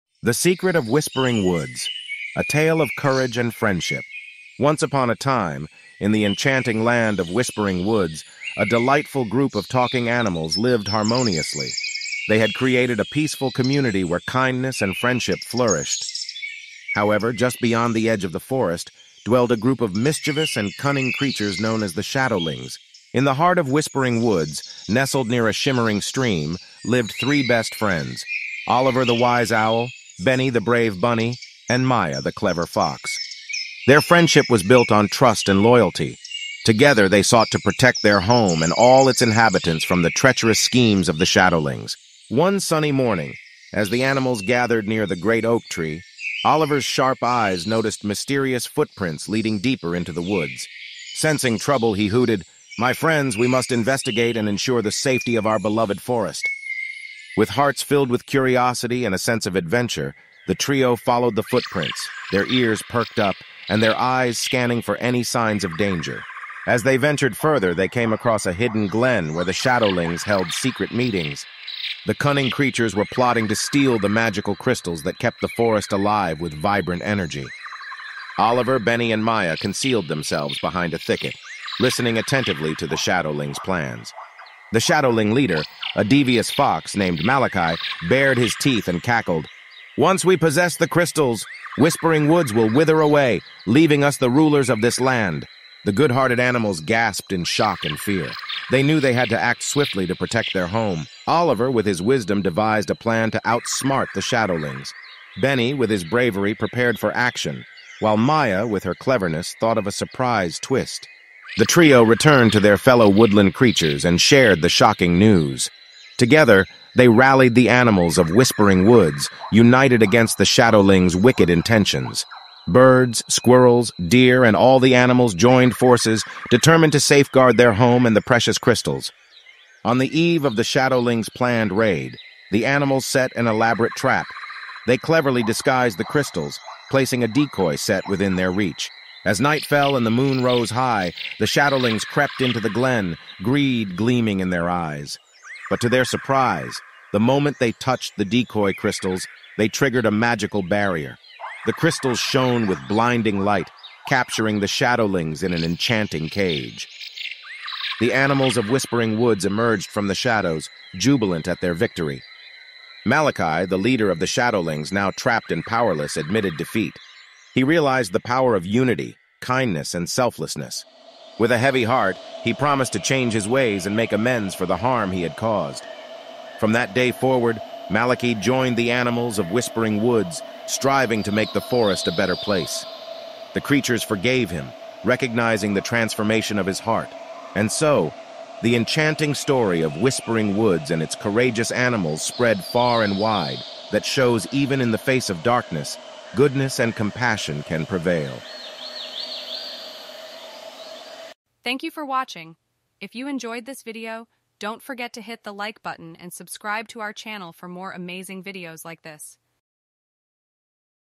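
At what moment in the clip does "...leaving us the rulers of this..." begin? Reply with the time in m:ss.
1:33.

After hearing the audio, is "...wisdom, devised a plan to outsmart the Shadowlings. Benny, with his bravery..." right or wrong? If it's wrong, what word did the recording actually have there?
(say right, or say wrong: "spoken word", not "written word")
right.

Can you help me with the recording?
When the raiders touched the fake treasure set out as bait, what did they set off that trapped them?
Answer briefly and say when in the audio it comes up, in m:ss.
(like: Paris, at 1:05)
a magical barrier, at 2:30.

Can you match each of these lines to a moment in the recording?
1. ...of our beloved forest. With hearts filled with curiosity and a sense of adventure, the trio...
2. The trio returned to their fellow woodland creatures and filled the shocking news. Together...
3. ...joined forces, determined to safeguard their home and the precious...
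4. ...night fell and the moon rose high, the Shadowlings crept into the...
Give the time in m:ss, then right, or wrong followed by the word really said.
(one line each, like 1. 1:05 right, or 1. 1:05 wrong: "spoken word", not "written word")
1. 0:55 right
2. 1:51 wrong: "shared", not "filled"
3. 2:05 right
4. 2:19 right.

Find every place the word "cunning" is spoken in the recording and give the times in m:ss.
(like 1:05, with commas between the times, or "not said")
0:20, 1:12.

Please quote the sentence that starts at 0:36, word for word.
Together, they sought to protect their home and all its inhabitants from the treacherous schemes of the Shadowlings.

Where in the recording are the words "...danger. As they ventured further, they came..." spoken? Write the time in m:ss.
1:05.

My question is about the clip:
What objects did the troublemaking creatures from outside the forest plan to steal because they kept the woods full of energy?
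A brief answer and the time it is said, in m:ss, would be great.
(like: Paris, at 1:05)
magical crystals, at 1:14.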